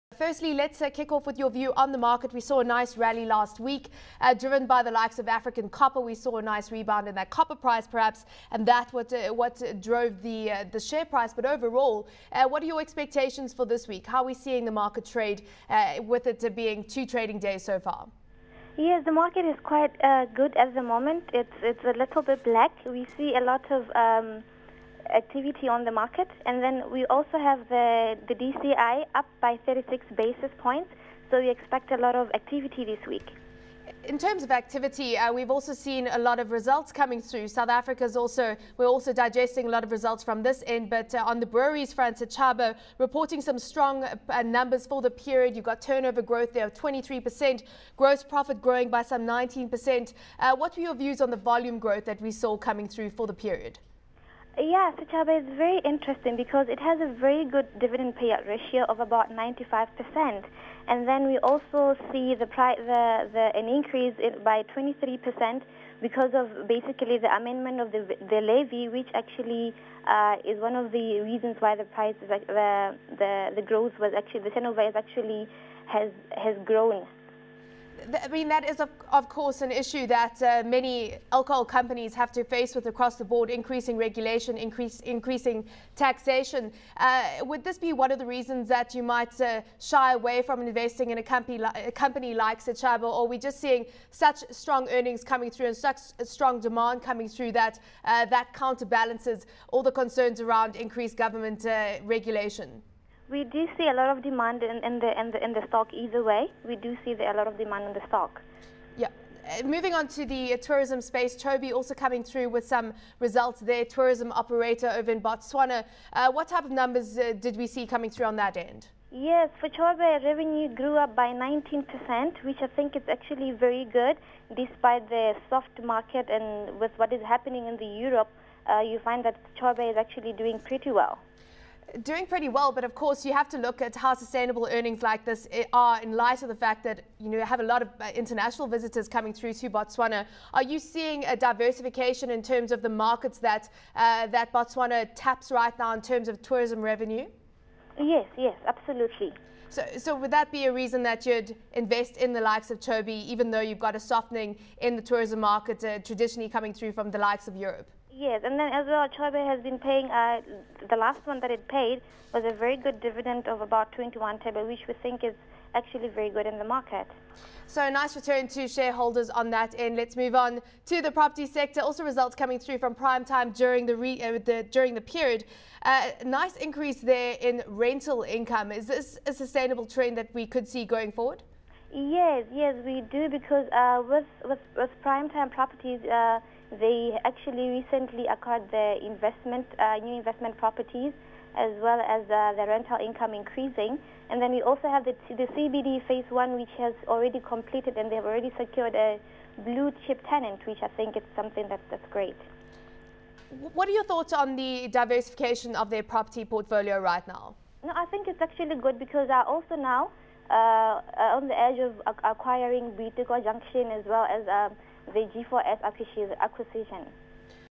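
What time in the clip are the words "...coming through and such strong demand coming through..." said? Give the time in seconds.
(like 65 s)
95 s.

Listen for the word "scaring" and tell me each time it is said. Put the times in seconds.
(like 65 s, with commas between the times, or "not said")
not said.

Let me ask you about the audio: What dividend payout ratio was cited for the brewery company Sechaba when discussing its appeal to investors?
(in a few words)
95%.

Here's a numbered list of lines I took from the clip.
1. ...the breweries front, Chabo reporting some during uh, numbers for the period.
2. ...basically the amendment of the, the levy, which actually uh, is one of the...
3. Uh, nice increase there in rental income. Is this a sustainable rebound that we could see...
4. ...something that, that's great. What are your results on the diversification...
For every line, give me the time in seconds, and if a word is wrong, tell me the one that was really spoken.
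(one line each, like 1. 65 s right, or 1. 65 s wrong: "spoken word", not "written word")
1. 41 s wrong: "strong", not "during"
2. 66 s right
3. 175 s wrong: "trend", not "rebound"
4. 201 s wrong: "thoughts", not "results".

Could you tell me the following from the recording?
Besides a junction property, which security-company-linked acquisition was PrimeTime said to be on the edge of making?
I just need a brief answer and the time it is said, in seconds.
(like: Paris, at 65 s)
G4S, at 215 s.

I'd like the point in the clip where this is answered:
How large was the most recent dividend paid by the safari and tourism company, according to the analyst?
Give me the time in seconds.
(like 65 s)
163 s.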